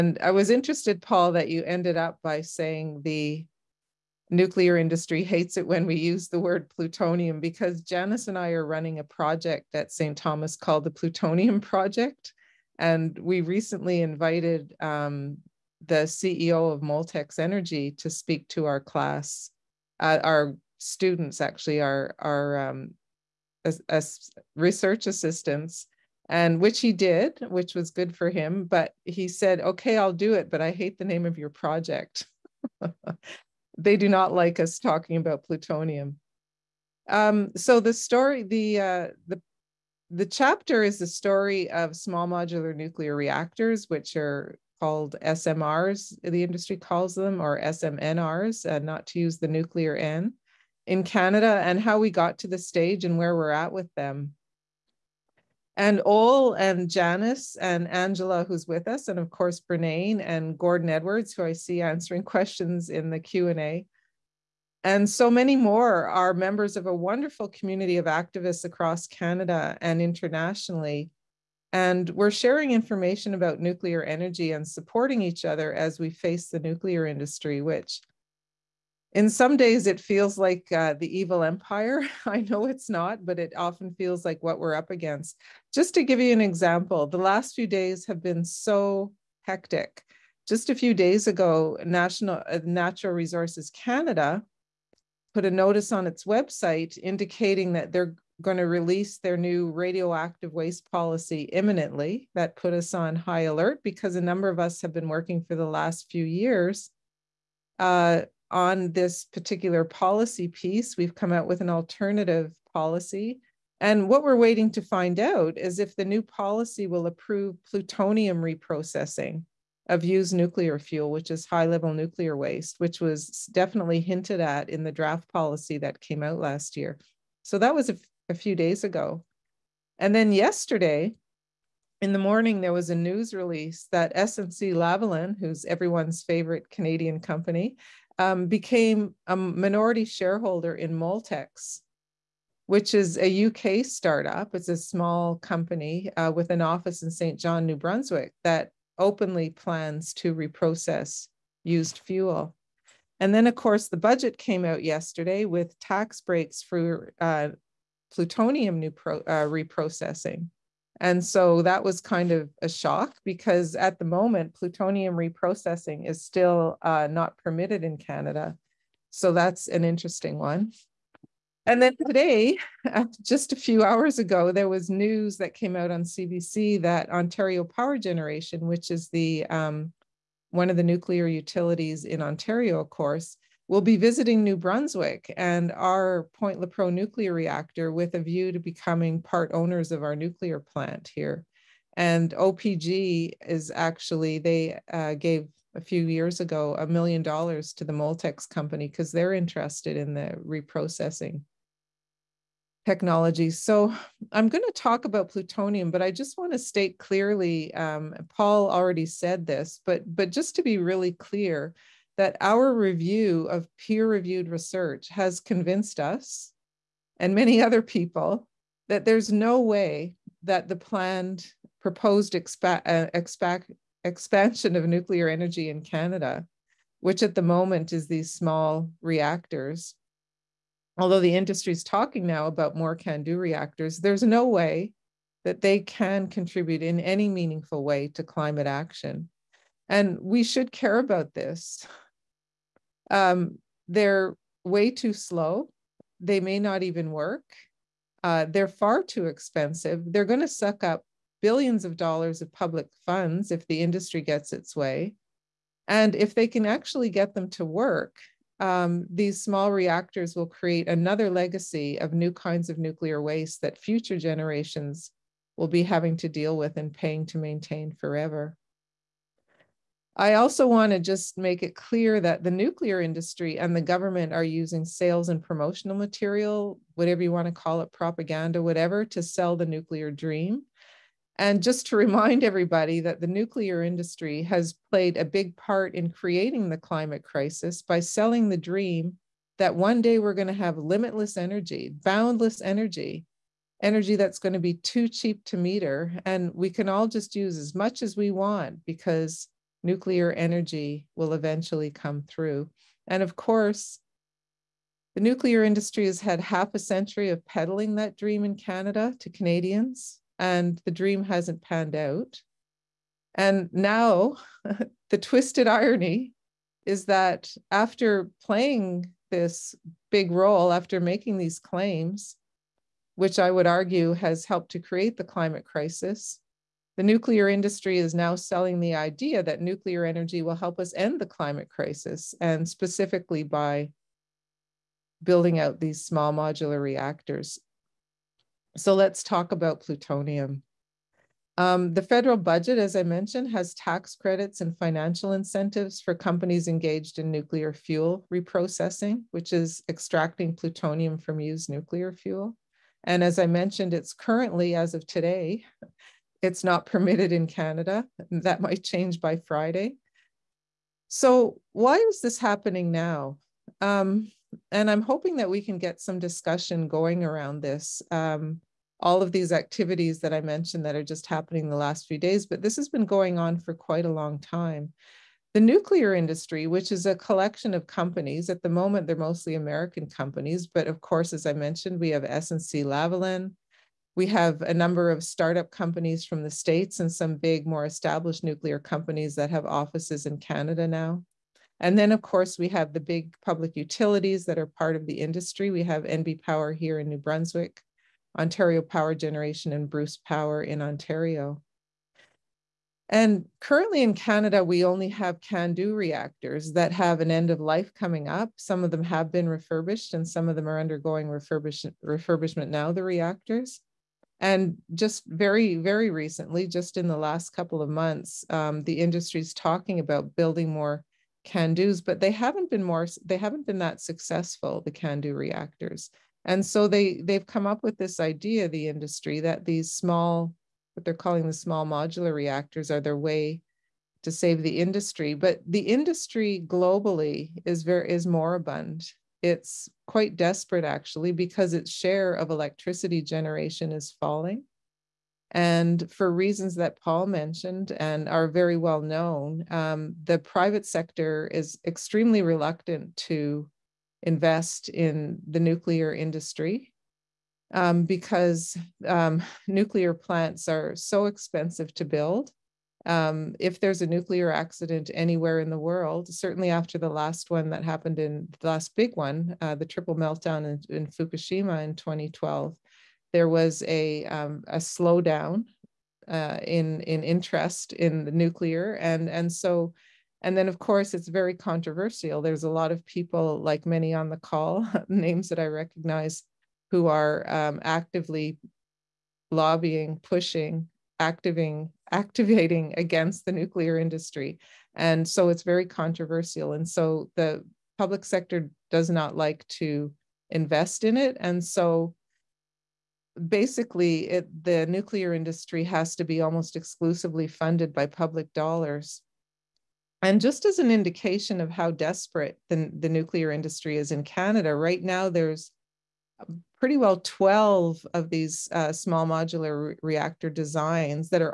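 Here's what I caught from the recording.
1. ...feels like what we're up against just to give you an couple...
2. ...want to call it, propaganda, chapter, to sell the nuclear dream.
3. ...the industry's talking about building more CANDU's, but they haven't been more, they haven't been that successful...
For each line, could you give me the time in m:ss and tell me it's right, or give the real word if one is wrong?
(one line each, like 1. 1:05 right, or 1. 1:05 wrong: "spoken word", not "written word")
1. 1:23 wrong: "example", not "couple"
2. 4:37 wrong: "whatever", not "chapter"
3. 6:58 right.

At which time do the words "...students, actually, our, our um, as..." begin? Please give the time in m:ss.
0:20.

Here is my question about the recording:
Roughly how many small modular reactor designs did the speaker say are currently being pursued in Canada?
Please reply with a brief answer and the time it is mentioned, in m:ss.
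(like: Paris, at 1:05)
12, at 8:37.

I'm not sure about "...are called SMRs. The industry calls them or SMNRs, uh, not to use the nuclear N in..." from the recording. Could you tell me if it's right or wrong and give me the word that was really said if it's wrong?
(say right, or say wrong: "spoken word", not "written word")
right.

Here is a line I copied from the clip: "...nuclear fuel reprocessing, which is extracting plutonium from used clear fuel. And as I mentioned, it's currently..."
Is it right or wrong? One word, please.
wrong.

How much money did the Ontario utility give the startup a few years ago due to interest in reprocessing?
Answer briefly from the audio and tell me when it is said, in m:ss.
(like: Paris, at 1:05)
$1 million, at 3:16.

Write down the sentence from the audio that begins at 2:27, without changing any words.
John, New Brunswick, that openly plans to reprocess used fuel.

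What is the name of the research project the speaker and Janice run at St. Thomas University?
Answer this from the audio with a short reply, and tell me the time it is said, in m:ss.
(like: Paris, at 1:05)
The Plutonium Project, at 0:10.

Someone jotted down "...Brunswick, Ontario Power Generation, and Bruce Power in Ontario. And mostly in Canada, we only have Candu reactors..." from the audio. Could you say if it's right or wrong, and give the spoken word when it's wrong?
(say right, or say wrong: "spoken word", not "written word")
wrong: "currently", not "mostly".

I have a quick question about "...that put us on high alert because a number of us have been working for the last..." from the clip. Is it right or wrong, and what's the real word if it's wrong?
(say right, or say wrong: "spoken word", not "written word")
right.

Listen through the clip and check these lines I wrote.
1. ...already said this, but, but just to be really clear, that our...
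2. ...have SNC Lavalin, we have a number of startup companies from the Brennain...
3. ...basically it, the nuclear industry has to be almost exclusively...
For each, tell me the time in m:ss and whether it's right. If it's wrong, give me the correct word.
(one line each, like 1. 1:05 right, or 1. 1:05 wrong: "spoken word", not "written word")
1. 3:28 right
2. 6:22 wrong: "States", not "Brennain"
3. 8:23 right.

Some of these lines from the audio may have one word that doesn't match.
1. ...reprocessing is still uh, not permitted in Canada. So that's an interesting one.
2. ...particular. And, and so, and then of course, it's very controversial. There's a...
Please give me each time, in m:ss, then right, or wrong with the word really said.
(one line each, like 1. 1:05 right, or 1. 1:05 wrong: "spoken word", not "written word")
1. 2:45 right
2. 7:58 wrong: "nuclear", not "particular".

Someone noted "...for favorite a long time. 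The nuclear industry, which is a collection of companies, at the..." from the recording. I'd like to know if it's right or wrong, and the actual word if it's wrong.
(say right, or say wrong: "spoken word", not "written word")
wrong: "quite", not "favorite".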